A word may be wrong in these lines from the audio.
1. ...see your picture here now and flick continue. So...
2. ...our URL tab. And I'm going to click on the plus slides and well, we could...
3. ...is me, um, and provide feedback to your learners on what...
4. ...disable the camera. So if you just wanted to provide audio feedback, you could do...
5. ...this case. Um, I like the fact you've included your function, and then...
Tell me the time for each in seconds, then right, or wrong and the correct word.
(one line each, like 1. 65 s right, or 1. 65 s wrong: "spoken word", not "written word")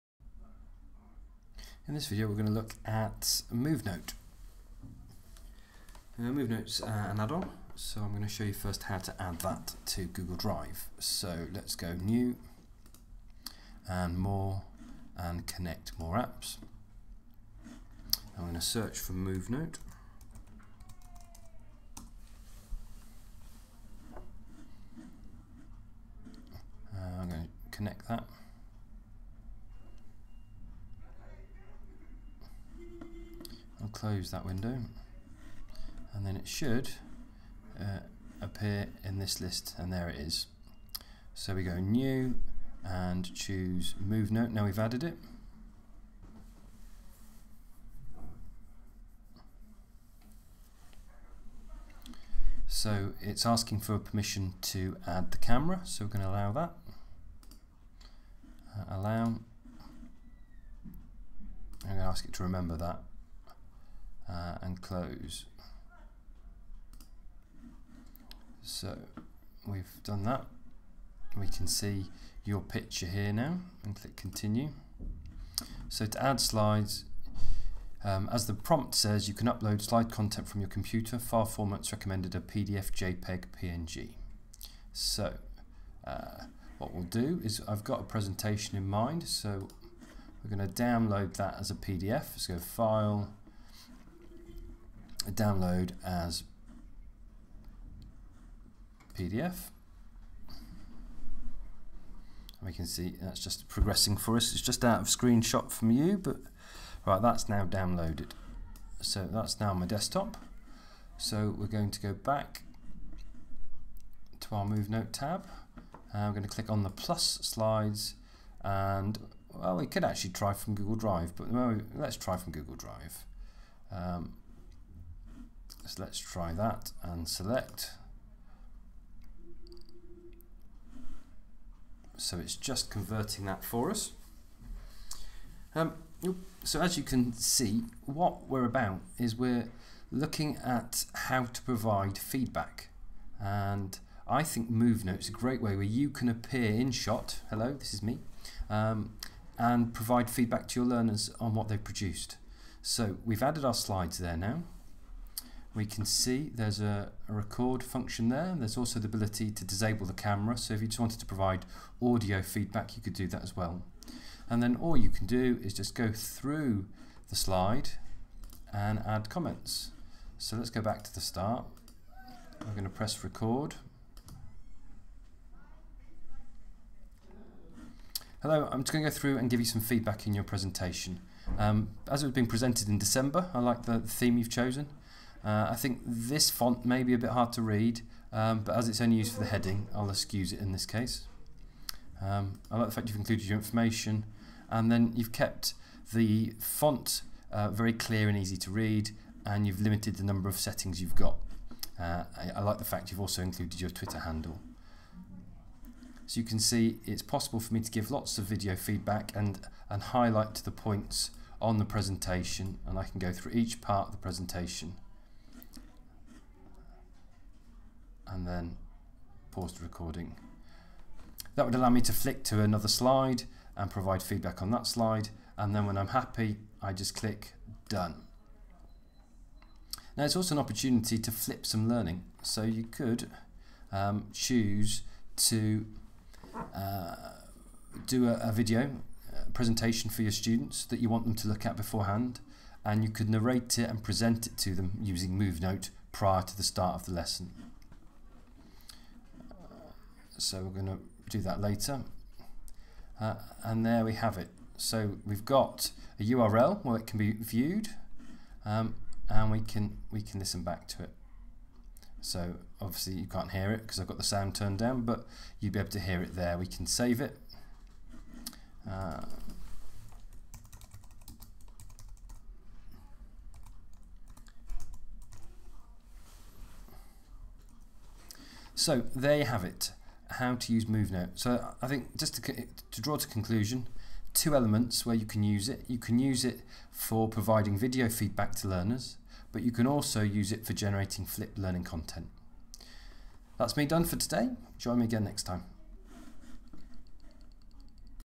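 1. 71 s wrong: "click", not "flick"
2. 114 s wrong: "MoveNote", not "URL"
3. 147 s right
4. 159 s right
5. 190 s wrong: "information", not "function".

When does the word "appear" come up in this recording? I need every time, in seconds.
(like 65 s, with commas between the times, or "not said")
38 s, 146 s.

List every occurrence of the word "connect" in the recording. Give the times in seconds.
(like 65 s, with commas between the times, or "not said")
15 s, 27 s.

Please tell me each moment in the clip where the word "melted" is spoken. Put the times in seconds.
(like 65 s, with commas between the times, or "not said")
not said.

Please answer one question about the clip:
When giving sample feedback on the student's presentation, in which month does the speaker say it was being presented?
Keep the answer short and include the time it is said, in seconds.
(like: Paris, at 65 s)
December, at 182 s.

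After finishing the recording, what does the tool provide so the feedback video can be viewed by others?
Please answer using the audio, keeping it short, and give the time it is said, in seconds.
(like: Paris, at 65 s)
A URL, at 256 s.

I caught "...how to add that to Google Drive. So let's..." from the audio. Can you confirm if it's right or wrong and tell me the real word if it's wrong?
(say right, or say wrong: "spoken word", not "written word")
right.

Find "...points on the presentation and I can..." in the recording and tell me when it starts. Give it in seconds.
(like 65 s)
210 s.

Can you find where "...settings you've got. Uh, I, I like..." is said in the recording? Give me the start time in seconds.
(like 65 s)
200 s.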